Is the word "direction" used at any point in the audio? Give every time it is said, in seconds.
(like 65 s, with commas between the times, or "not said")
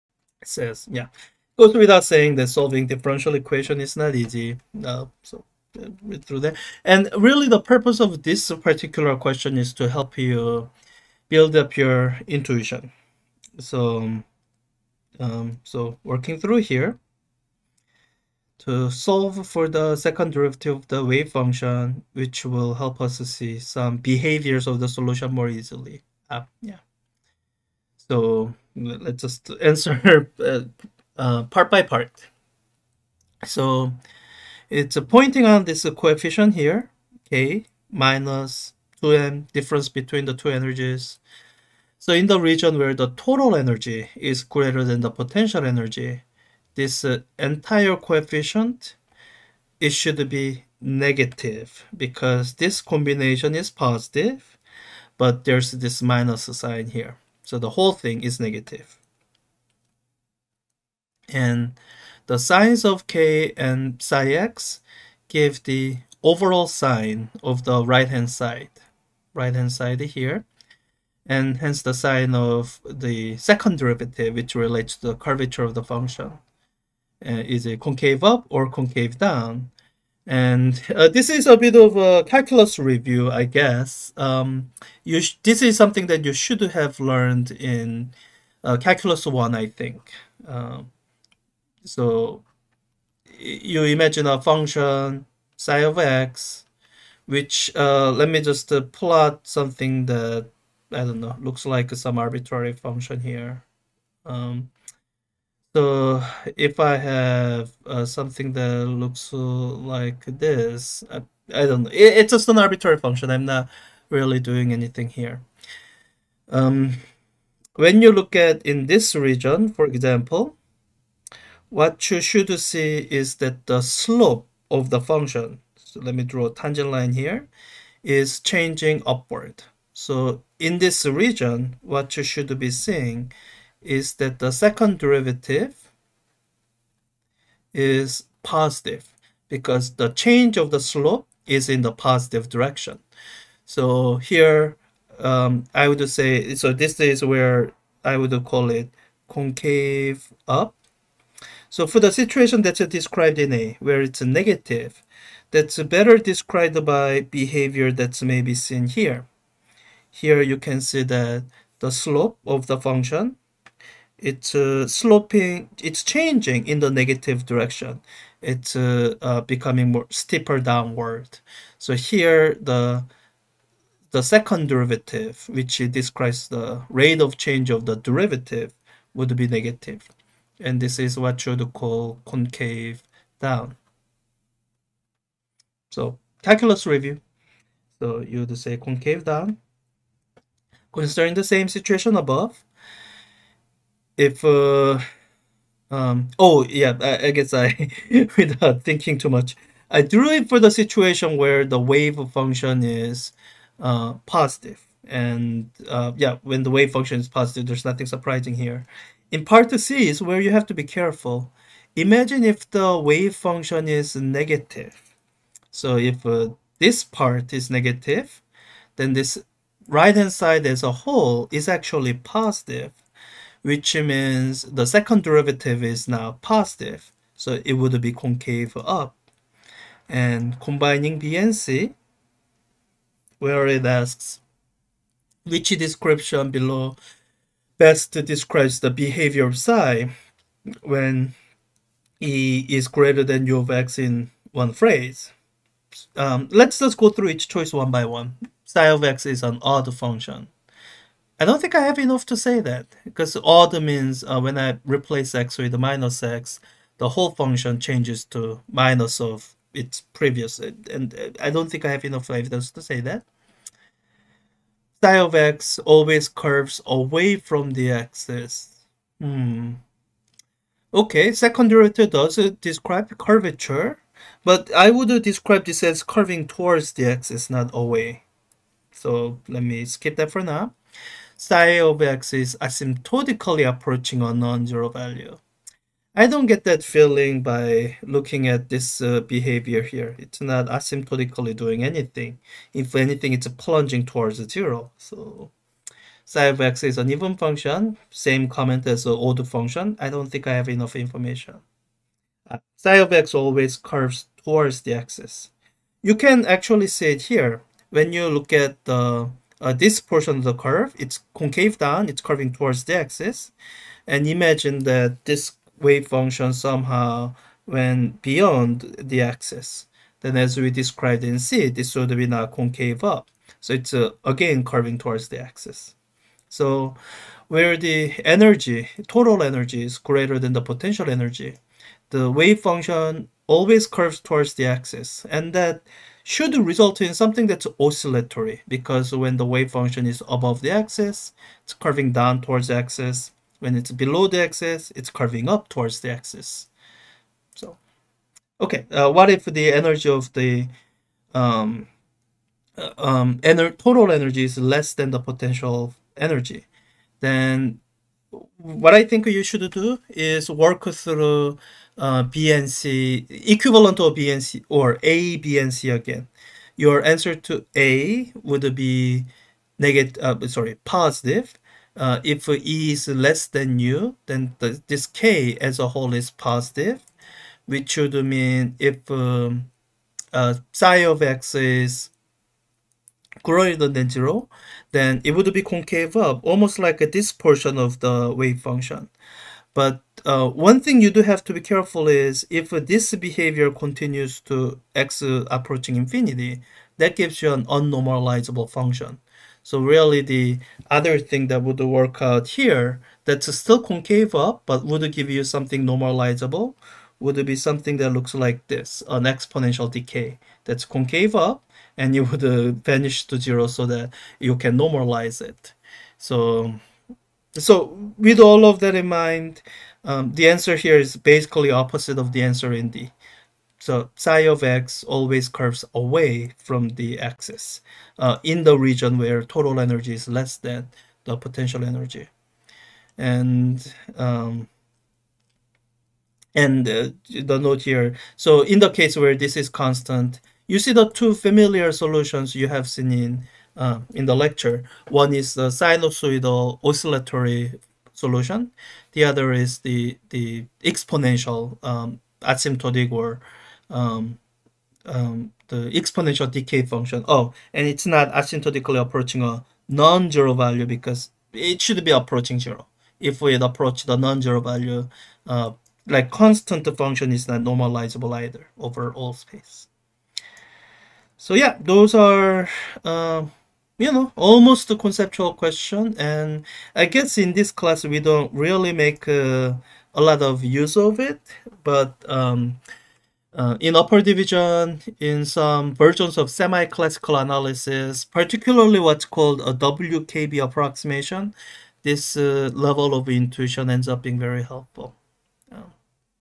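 142 s, 167 s.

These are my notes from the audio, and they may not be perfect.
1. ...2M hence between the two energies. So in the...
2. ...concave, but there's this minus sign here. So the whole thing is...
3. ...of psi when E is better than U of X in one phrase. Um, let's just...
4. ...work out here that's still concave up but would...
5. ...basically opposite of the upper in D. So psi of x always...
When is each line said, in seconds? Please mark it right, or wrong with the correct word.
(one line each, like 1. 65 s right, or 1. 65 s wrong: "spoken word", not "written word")
1. 39 s wrong: "difference", not "hence"
2. 53 s wrong: "positive", not "concave"
3. 239 s wrong: "greater", not "better"
4. 401 s right
5. 421 s wrong: "answer", not "upper".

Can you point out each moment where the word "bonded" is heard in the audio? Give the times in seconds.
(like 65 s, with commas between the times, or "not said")
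not said.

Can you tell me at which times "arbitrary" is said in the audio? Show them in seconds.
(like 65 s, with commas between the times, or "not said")
102 s, 112 s.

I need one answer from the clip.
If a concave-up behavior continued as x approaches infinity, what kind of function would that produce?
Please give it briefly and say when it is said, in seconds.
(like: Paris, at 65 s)
Unnormalizable, at 397 s.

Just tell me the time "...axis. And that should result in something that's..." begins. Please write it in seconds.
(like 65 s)
334 s.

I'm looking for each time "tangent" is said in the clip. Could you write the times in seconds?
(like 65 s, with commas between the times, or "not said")
126 s.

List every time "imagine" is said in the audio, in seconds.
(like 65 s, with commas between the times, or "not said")
93 s, 211 s, 314 s.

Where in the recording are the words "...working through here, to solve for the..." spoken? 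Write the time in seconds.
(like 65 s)
16 s.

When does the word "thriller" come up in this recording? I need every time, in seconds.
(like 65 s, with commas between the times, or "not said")
not said.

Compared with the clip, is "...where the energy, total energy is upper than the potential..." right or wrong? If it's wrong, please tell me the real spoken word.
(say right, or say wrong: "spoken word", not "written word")
wrong: "greater", not "upper".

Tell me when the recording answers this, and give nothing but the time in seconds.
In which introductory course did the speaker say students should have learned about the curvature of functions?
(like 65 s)
88 s.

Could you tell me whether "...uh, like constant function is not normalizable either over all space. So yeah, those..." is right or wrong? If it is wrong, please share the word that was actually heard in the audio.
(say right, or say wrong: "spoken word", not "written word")
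right.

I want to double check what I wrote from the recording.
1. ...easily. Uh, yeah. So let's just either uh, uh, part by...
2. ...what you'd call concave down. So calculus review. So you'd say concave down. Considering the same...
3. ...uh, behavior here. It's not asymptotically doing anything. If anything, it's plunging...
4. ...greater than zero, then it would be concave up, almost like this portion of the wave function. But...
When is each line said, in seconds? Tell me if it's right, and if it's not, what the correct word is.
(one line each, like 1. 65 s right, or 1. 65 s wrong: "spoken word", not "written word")
1. 25 s wrong: "answer", not "either"
2. 181 s right
3. 289 s right
4. 383 s right.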